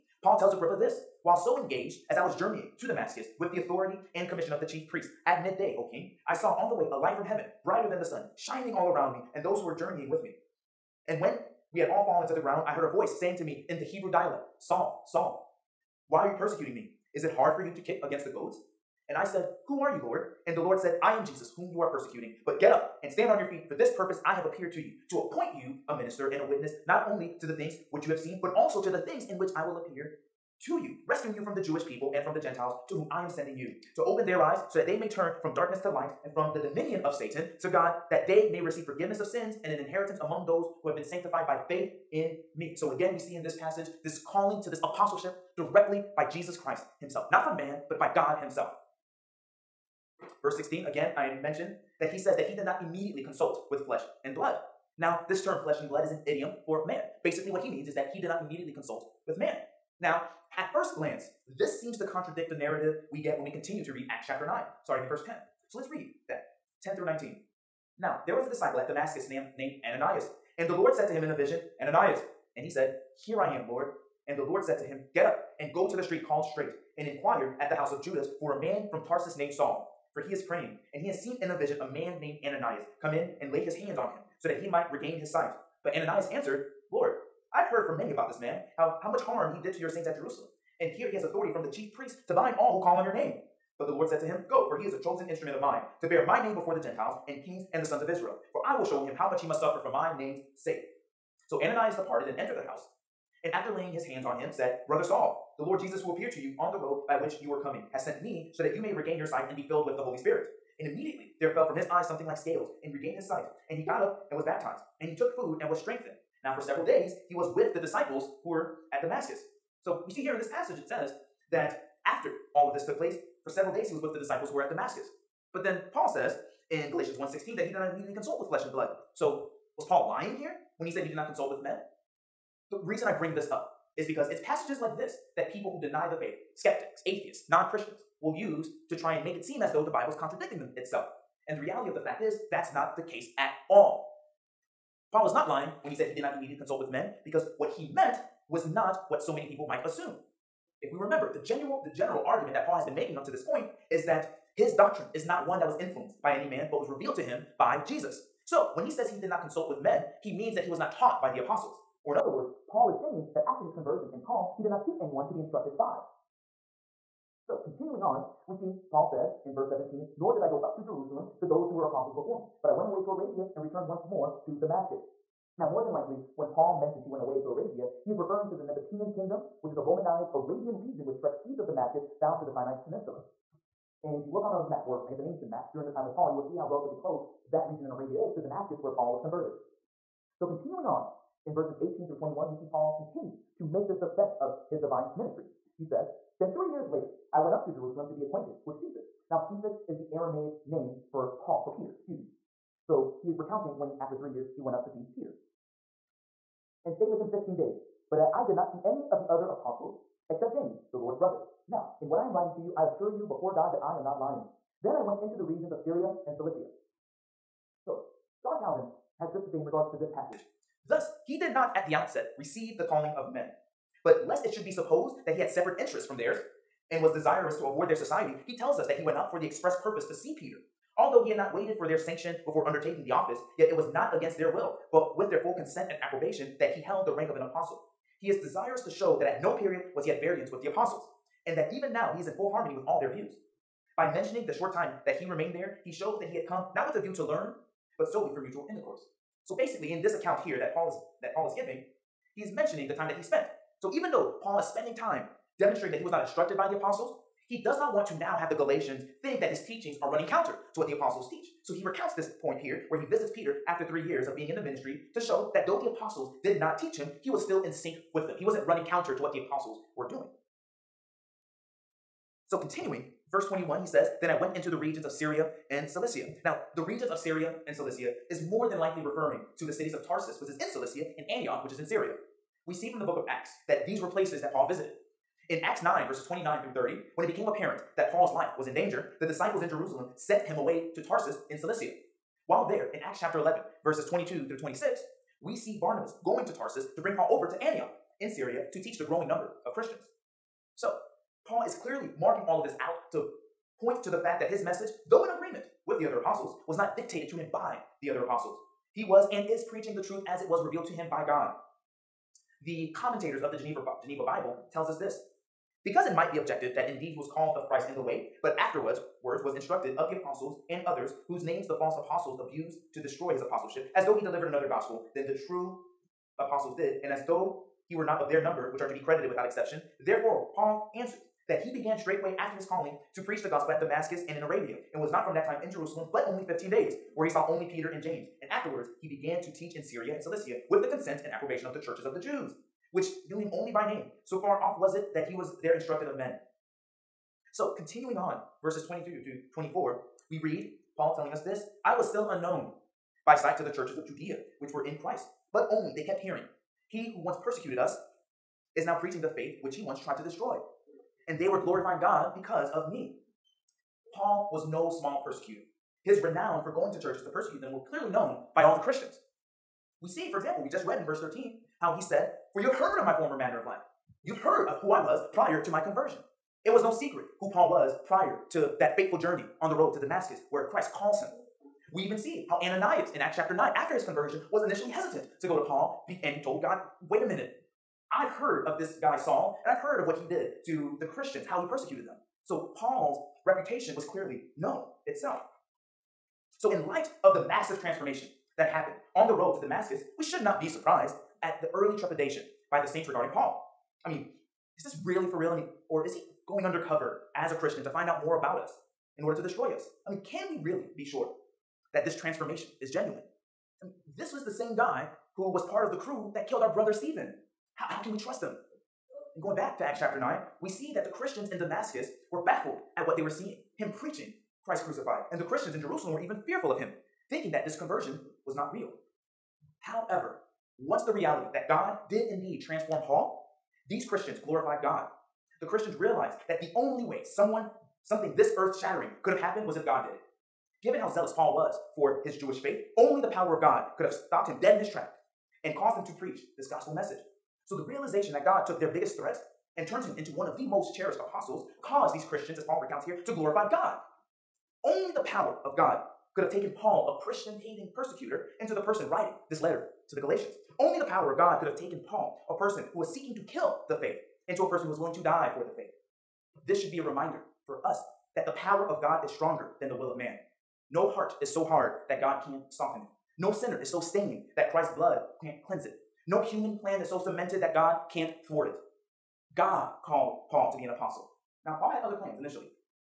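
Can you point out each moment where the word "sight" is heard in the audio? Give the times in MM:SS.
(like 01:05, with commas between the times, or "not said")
01:25, 01:49, 01:53, 05:53.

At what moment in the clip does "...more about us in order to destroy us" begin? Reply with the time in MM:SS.
06:48.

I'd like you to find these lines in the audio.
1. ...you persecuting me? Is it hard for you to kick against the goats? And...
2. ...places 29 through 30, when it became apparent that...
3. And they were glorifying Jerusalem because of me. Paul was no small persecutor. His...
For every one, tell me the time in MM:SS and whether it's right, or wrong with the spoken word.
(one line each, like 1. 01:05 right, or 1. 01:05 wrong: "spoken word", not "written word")
1. 00:16 right
2. 04:46 wrong: "verses", not "places"
3. 06:01 wrong: "God", not "Jerusalem".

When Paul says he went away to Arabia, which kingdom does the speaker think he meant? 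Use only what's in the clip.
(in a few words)
Nabatean kingdom.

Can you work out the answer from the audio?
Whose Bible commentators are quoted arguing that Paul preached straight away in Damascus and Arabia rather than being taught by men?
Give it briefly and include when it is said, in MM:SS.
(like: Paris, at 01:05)
Geneva Bible, at 05:13.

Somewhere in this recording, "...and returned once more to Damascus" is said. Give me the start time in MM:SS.
02:53.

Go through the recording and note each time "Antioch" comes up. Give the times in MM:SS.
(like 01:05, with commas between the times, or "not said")
04:41, 04:57.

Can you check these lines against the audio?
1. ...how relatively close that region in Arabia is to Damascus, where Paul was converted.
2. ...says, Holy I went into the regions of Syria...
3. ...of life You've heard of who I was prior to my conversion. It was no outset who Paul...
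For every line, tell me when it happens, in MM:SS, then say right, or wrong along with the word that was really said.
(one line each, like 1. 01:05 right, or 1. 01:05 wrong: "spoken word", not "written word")
1. 03:06 right
2. 04:33 wrong: "Then", not "Holy"
3. 06:13 wrong: "secret", not "outset".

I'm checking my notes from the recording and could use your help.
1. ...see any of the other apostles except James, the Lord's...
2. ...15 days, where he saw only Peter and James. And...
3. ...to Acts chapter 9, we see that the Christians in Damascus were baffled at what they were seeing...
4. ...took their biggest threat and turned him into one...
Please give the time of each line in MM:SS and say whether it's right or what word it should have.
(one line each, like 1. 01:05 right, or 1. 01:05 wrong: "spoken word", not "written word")
1. 03:28 right
2. 05:36 right
3. 06:59 right
4. 07:28 right.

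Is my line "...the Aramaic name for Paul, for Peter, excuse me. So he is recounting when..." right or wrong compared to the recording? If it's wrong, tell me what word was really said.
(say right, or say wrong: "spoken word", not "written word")
right.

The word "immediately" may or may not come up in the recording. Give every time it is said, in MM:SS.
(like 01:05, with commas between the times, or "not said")
00:52, 00:58, 01:50, 02:07, 02:26.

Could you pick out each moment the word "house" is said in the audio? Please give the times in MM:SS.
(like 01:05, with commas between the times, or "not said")
01:17, 01:42.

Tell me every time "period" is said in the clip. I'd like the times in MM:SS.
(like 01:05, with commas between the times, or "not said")
03:59.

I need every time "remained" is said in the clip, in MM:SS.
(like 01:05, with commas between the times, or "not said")
04:05.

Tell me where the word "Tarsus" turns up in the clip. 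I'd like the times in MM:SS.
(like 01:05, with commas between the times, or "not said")
01:19, 04:40, 04:51, 04:56.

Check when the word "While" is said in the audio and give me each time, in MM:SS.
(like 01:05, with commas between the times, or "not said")
00:01, 04:52.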